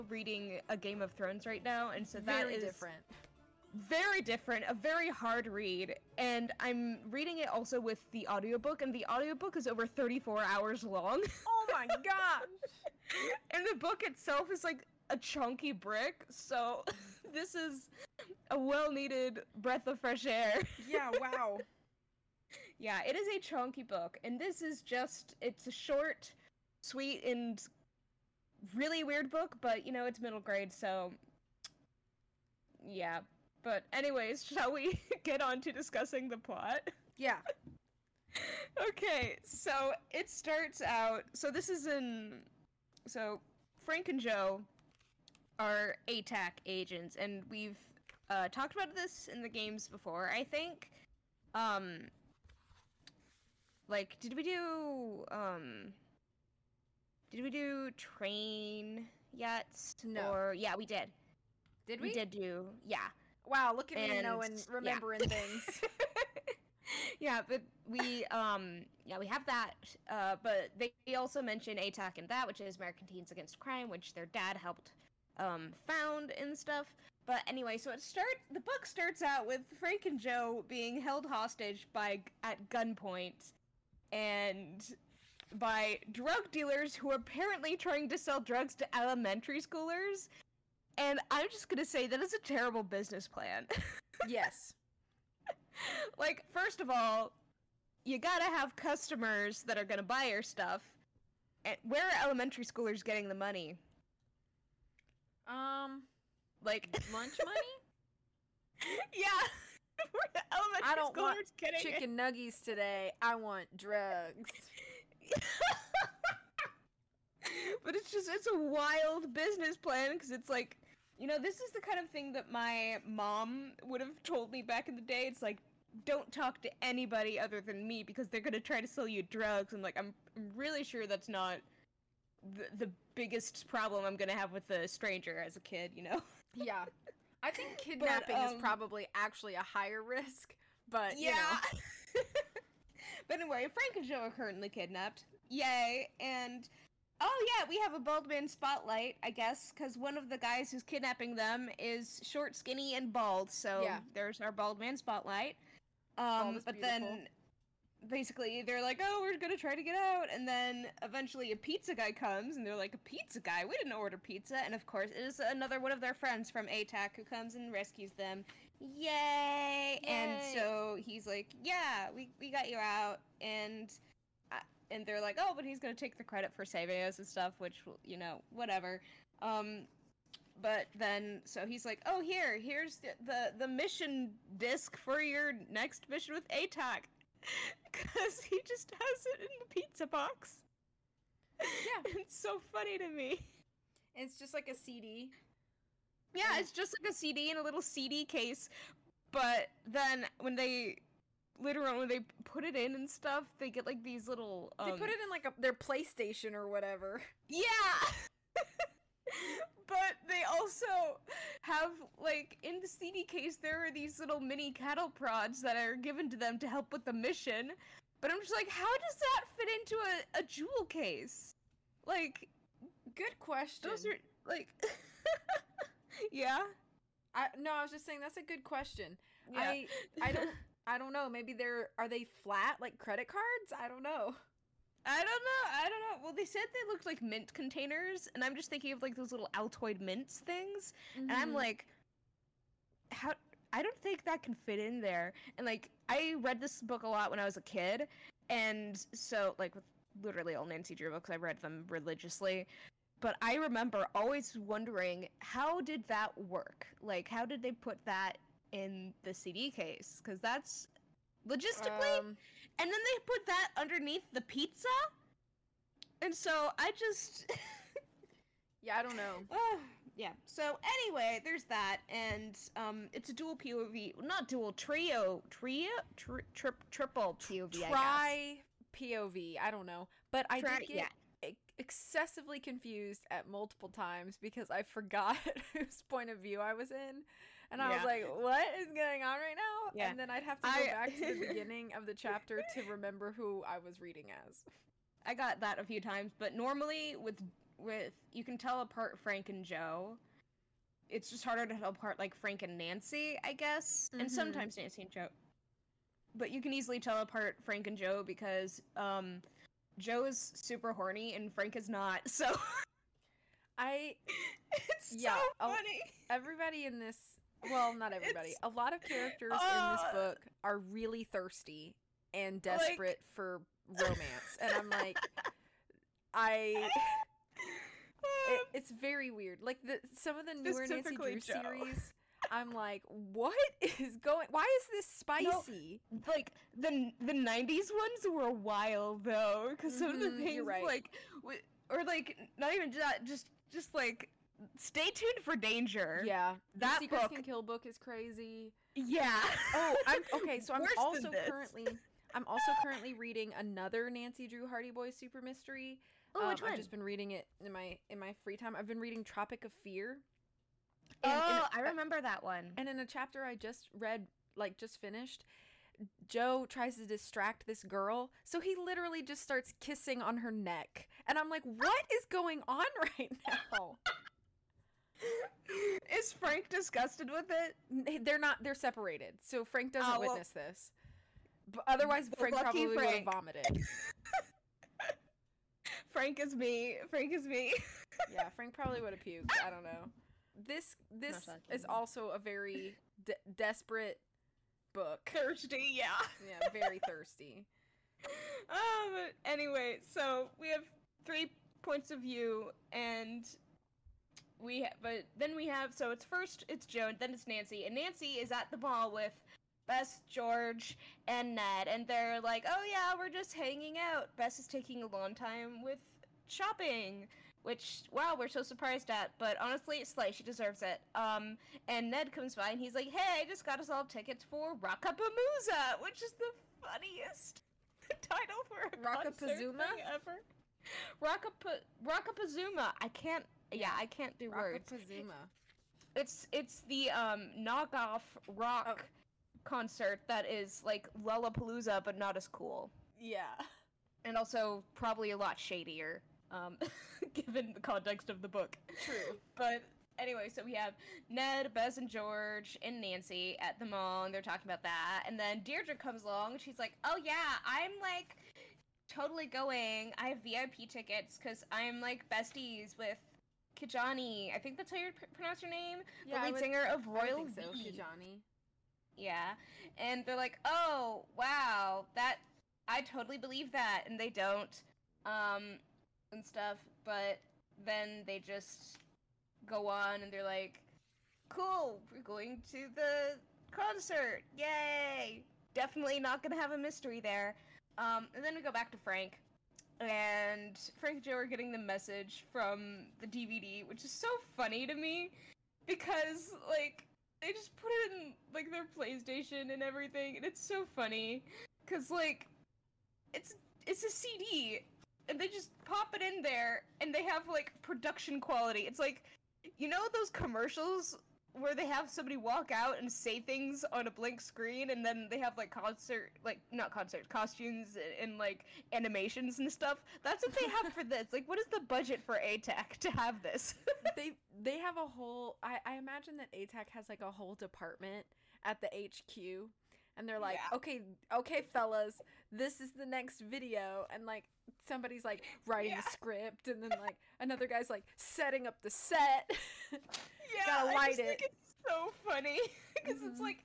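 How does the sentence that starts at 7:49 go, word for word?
Yeah, and they're like, "Oh, wow, that I totally believe that," and they don't.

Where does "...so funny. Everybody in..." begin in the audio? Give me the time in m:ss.
5:15.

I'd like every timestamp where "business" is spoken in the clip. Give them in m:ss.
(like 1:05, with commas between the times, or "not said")
1:32, 1:59.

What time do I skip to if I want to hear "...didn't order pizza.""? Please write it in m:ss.
2:43.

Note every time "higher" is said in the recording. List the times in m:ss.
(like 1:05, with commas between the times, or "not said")
2:19.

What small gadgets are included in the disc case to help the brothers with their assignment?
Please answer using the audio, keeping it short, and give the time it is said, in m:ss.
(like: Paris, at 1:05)
Mini cattle prods, at 3:34.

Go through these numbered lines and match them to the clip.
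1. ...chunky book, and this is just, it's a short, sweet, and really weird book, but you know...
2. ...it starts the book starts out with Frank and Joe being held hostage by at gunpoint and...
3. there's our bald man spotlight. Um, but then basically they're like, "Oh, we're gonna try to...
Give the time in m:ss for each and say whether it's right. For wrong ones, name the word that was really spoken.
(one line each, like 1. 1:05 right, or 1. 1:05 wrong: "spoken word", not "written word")
1. 0:23 right
2. 1:17 right
3. 2:34 right.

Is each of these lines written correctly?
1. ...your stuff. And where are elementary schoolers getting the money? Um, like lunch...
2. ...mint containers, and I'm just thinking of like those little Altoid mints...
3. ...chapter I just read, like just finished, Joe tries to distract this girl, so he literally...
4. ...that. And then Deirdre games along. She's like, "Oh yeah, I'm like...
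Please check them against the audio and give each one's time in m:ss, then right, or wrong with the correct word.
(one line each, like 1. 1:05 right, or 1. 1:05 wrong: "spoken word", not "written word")
1. 1:40 right
2. 3:57 right
3. 6:03 right
4. 7:34 wrong: "comes", not "games".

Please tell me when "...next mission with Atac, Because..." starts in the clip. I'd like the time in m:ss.
3:05.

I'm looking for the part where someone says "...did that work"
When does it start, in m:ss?
4:15.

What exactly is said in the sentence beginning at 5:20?
book are really thirsty and desperate like, for romance.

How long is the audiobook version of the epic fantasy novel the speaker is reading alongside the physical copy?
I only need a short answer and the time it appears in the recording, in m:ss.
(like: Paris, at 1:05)
Over 34 hours, at 0:09.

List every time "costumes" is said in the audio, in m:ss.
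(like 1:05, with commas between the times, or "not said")
8:37.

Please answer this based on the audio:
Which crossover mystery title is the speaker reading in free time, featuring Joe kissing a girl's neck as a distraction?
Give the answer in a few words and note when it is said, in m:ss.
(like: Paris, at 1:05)
Tropic of Fear, at 5:59.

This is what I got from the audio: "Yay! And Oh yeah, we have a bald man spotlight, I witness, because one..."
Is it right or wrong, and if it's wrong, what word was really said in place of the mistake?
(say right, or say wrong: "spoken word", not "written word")
wrong: "guess", not "witness".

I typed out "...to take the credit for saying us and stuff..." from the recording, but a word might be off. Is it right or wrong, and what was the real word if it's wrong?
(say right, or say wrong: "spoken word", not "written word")
wrong: "saving", not "saying".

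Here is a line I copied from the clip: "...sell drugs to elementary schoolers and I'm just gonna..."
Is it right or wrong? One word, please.
right.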